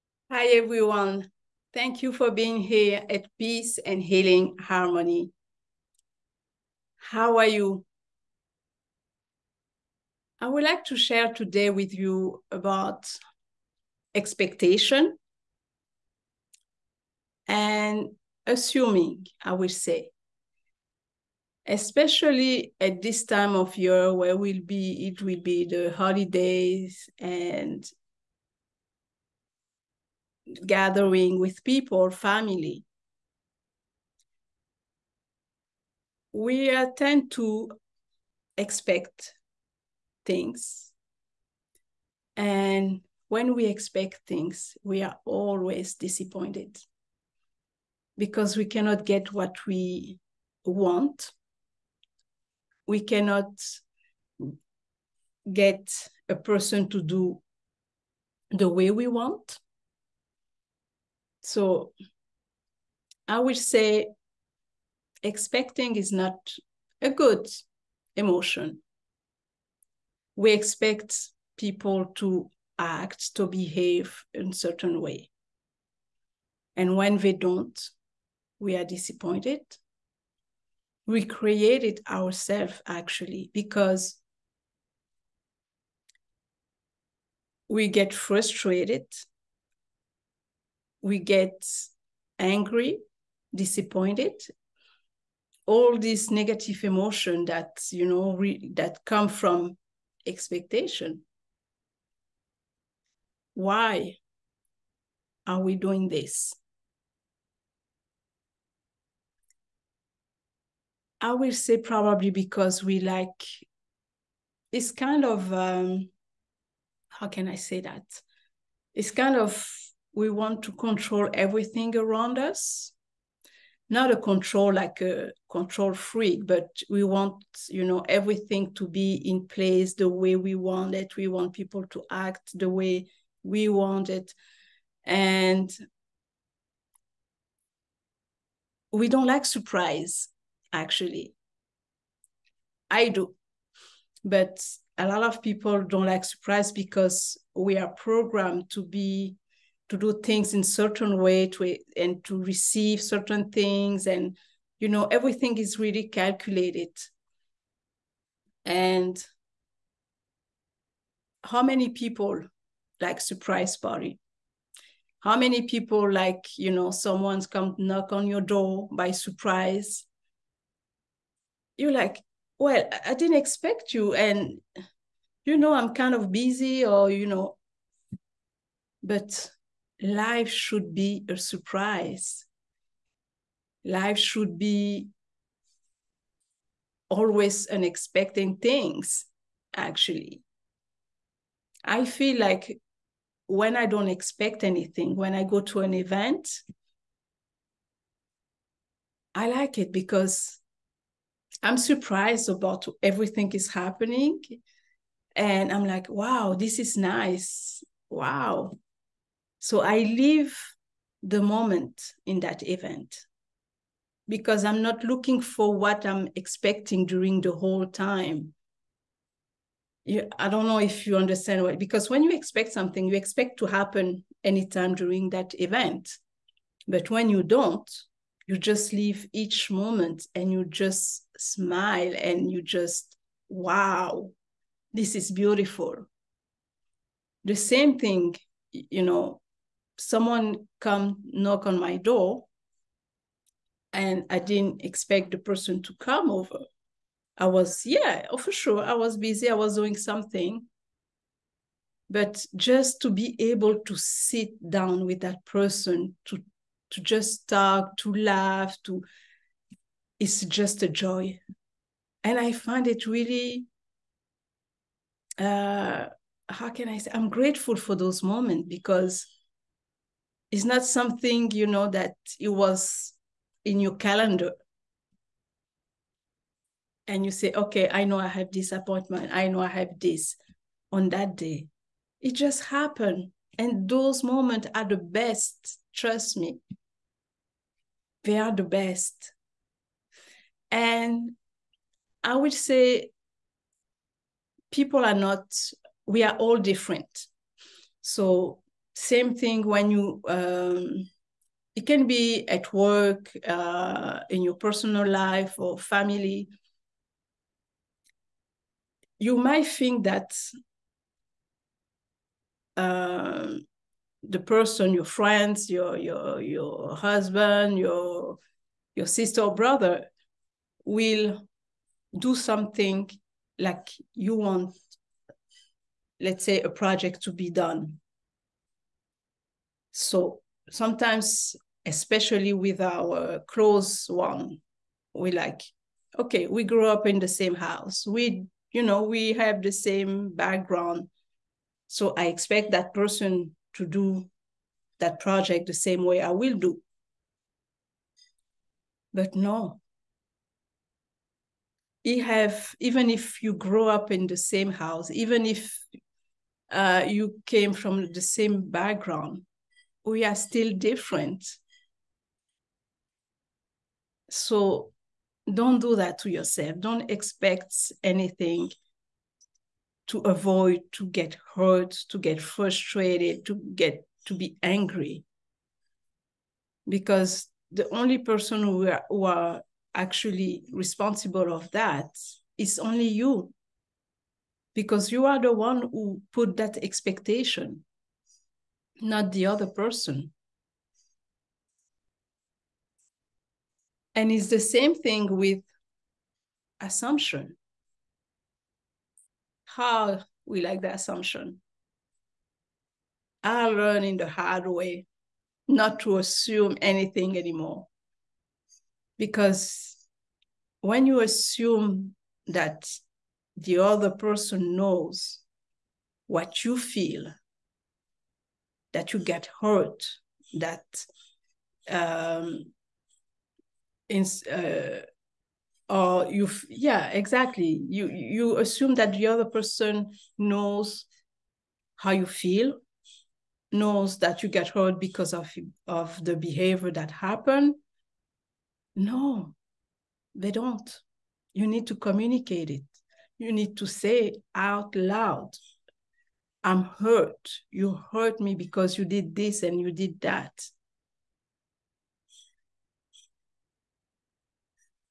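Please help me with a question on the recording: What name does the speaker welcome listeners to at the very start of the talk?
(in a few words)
Peace and Healing Harmony.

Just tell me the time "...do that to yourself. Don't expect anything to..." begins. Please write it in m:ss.
6:05.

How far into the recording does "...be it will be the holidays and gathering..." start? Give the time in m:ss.
0:24.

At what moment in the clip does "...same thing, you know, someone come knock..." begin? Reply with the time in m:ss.
3:57.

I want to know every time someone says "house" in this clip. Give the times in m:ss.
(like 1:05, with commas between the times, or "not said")
5:37, 5:54.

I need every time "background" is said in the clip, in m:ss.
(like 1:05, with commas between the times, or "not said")
5:40, 5:58.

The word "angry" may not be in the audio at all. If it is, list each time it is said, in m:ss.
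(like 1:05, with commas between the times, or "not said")
1:32, 6:14.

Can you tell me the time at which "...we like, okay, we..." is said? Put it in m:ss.
5:35.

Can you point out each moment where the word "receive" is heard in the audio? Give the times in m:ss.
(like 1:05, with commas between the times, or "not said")
2:32.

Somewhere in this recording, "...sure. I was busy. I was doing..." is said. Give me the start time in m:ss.
4:08.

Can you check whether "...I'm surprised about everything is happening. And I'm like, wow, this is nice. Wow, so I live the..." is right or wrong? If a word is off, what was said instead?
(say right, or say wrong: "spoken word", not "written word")
right.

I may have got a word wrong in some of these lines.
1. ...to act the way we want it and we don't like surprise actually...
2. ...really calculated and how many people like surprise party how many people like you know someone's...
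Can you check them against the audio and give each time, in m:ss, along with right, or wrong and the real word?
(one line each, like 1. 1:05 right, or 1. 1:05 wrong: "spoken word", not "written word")
1. 2:11 right
2. 2:35 right.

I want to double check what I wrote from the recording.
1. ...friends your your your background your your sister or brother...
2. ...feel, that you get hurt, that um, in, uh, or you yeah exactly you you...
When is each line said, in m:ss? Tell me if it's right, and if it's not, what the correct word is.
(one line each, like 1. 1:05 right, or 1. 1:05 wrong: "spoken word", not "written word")
1. 5:15 wrong: "husband", not "background"
2. 6:56 right.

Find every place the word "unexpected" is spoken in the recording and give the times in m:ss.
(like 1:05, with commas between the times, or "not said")
3:07.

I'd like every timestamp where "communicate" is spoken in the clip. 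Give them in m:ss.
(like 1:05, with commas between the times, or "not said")
7:21.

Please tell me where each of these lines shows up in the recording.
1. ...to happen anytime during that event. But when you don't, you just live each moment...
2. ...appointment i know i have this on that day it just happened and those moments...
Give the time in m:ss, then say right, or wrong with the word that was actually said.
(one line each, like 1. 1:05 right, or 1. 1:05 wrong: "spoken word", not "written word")
1. 3:43 right
2. 4:38 right.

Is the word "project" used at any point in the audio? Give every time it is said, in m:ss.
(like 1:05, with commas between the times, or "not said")
5:26, 5:45.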